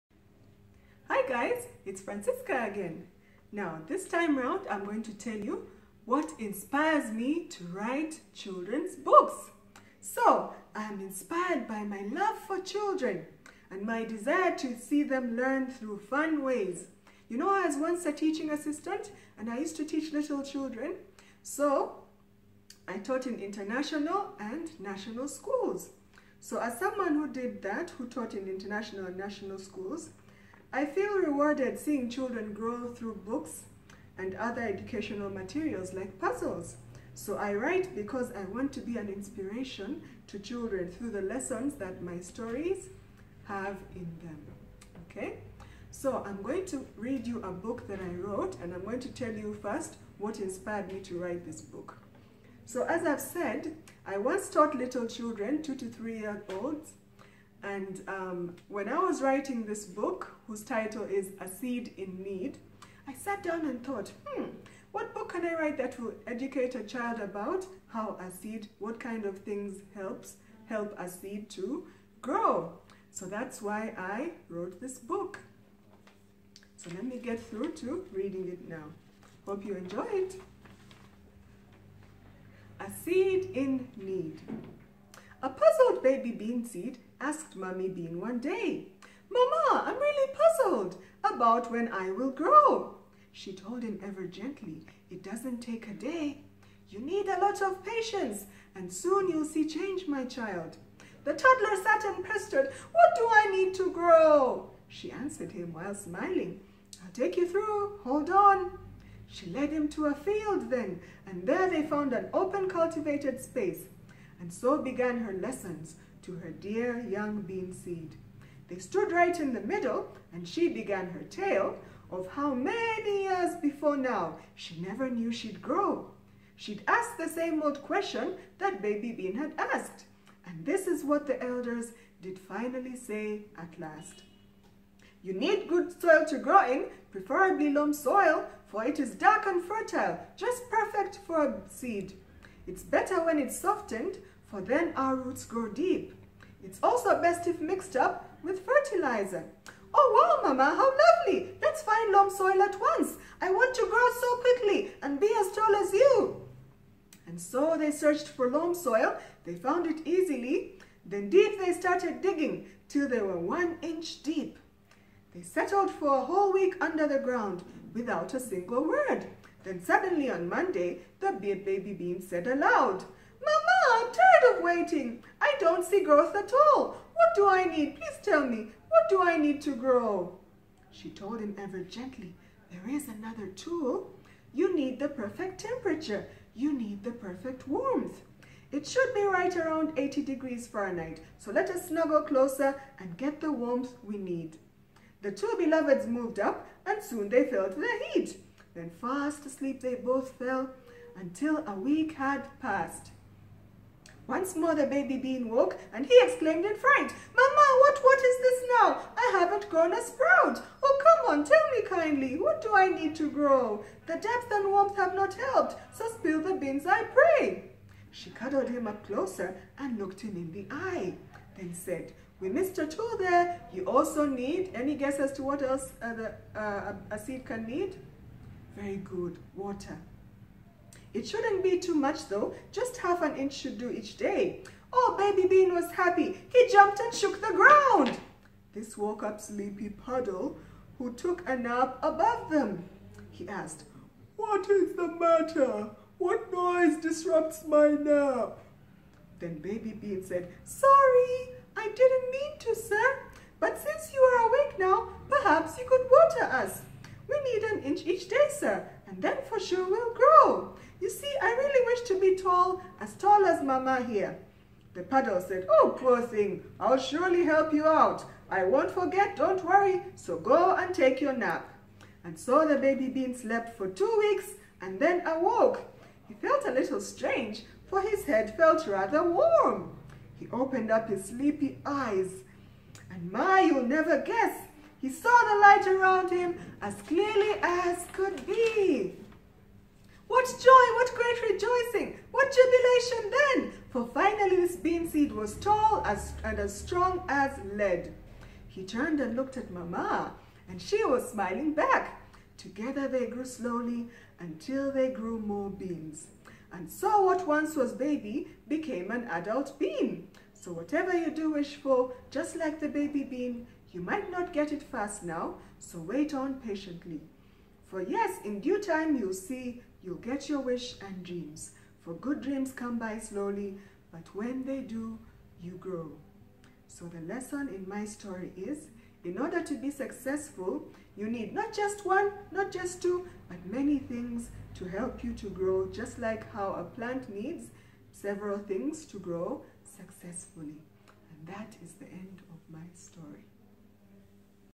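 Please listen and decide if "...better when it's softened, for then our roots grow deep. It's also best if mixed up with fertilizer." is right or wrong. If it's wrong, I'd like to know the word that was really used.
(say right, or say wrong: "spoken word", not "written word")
right.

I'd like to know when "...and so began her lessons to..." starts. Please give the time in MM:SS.
01:54.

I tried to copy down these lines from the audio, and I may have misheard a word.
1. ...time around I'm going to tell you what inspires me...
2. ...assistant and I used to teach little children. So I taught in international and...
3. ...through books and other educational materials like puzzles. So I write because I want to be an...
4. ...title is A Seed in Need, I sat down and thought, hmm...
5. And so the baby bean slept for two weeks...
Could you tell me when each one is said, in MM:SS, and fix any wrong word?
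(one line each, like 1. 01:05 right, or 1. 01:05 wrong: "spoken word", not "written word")
1. 00:04 right
2. 00:18 right
3. 00:32 right
4. 01:00 right
5. 04:32 right.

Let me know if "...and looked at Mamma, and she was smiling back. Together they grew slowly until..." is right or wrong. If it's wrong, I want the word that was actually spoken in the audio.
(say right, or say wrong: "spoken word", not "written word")
right.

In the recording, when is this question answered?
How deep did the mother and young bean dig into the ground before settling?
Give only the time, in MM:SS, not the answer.
02:43.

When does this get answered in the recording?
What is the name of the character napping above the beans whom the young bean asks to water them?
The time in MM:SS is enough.
03:59.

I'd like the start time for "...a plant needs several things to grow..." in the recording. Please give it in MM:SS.
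05:36.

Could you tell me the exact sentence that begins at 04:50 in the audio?
What joy, what great rejoicing, what jubilation then!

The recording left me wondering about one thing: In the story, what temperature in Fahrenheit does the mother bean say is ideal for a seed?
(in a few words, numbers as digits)
80 degrees.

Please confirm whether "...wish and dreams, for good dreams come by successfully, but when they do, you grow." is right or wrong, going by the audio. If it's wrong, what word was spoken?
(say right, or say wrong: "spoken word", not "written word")
wrong: "slowly", not "successfully".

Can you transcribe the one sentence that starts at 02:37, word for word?
And so they searched for loam soil.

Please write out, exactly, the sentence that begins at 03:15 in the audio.
The two beloveds moved up and soon they felt the heat.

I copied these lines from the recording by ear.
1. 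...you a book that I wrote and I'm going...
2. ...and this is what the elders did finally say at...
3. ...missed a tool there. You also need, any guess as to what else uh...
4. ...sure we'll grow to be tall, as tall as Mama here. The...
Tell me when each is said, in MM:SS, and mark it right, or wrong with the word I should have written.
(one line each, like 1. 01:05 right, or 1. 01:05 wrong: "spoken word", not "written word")
1. 00:47 right
2. 02:10 right
3. 03:42 right
4. 04:19 right.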